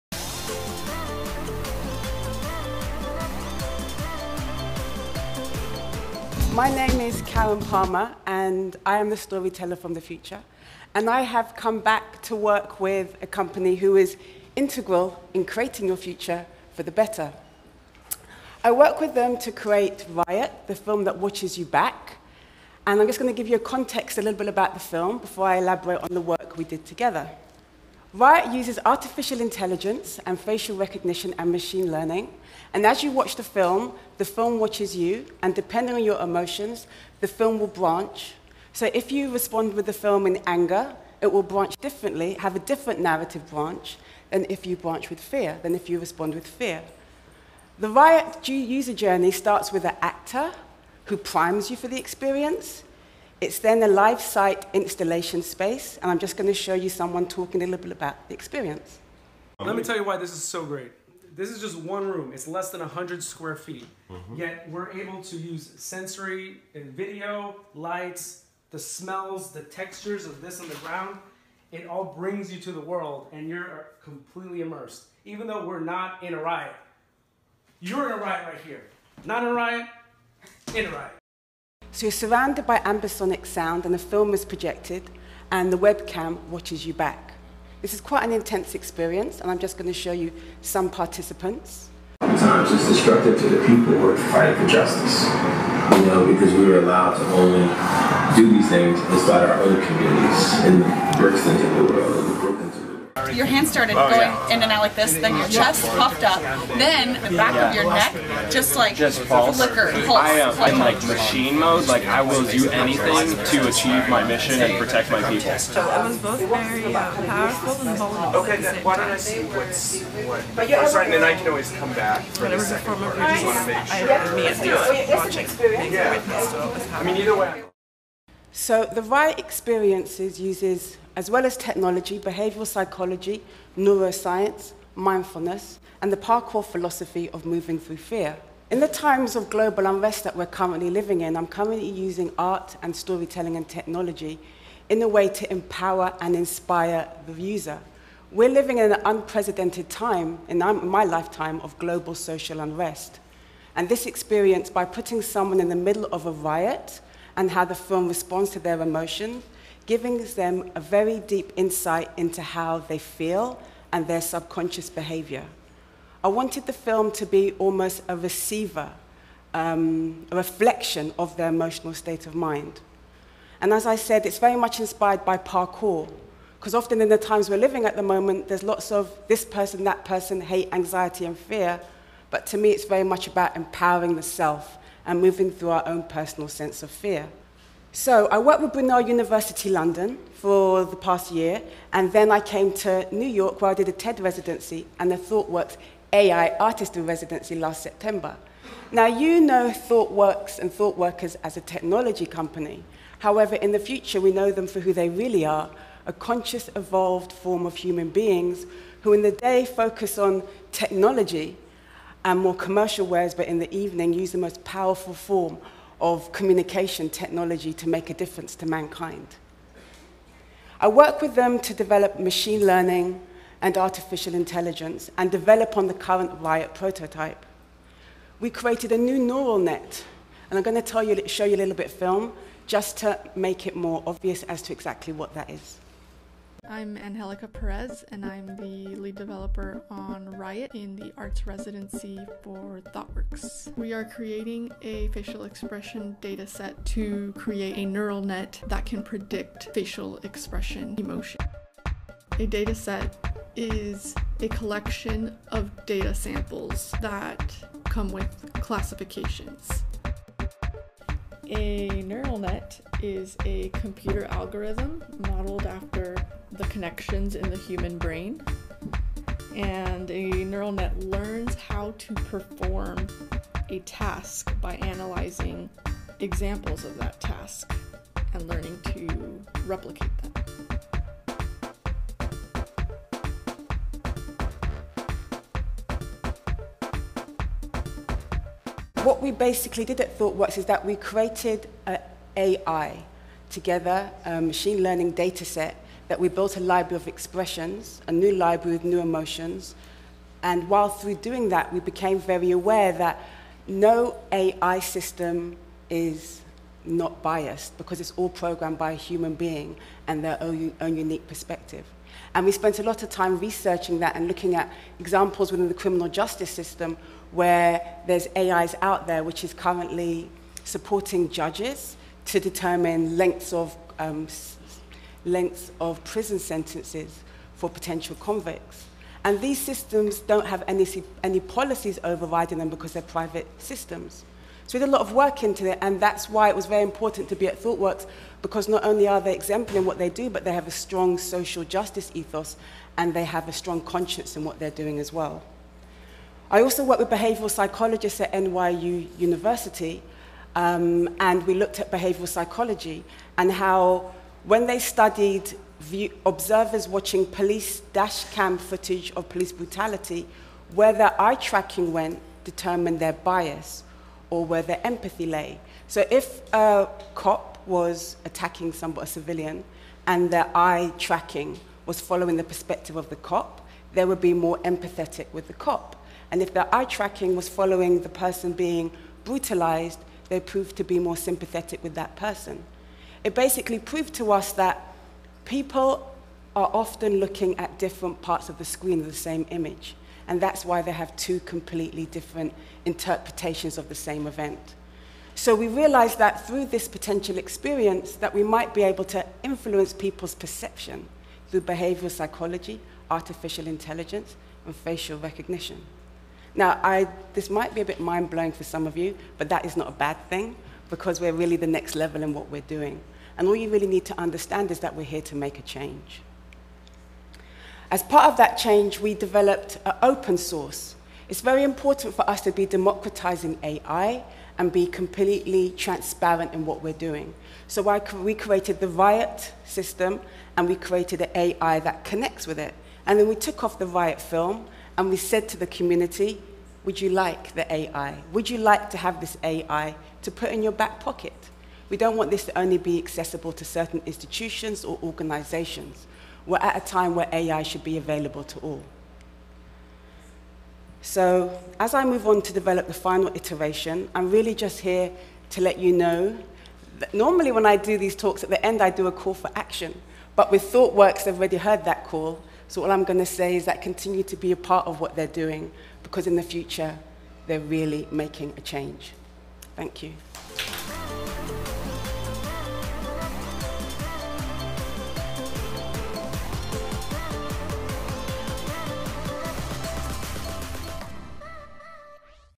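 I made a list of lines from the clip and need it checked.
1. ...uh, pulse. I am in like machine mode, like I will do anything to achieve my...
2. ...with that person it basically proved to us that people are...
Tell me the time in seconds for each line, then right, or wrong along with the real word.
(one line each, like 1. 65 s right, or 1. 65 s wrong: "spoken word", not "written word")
1. 109 s right
2. 381 s right.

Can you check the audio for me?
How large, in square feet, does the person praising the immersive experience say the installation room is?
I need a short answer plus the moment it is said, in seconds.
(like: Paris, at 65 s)
less than 100 square feet, at 62 s.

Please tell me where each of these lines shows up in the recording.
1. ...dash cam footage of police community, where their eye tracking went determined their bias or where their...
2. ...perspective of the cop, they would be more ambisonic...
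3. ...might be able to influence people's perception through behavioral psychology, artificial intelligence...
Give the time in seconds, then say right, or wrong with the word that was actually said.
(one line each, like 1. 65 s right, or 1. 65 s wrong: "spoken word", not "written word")
1. 357 s wrong: "brutality", not "community"
2. 372 s wrong: "empathetic", not "ambisonic"
3. 398 s right.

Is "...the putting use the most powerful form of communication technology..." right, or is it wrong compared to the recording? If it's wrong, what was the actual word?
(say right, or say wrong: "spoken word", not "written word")
wrong: "evening", not "putting".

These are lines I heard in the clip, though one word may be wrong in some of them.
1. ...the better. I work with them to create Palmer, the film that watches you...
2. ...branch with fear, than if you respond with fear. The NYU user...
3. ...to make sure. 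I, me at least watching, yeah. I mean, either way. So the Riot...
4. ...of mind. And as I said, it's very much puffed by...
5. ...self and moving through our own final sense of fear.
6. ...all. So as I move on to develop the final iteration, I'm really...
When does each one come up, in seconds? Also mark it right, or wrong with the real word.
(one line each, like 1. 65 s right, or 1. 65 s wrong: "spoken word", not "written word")
1. 16 s wrong: "Riot", not "Palmer"
2. 44 s wrong: "Riot", not "NYU"
3. 123 s right
4. 172 s wrong: "inspired", not "puffed"
5. 184 s wrong: "personal", not "final"
6. 448 s right.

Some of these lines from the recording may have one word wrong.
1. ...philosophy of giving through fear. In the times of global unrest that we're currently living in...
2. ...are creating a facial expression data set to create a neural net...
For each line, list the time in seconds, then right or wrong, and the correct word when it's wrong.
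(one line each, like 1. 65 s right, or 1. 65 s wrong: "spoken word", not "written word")
1. 136 s wrong: "moving", not "giving"
2. 243 s right.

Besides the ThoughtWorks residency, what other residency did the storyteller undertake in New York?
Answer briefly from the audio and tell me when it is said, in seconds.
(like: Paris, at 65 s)
TED residency, at 193 s.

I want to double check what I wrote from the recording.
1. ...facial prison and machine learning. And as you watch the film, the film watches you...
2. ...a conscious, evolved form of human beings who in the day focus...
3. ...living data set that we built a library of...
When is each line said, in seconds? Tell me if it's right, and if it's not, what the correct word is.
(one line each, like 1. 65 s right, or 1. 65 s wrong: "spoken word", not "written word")
1. 30 s wrong: "recognition", not "prison"
2. 206 s right
3. 294 s wrong: "learning", not "living".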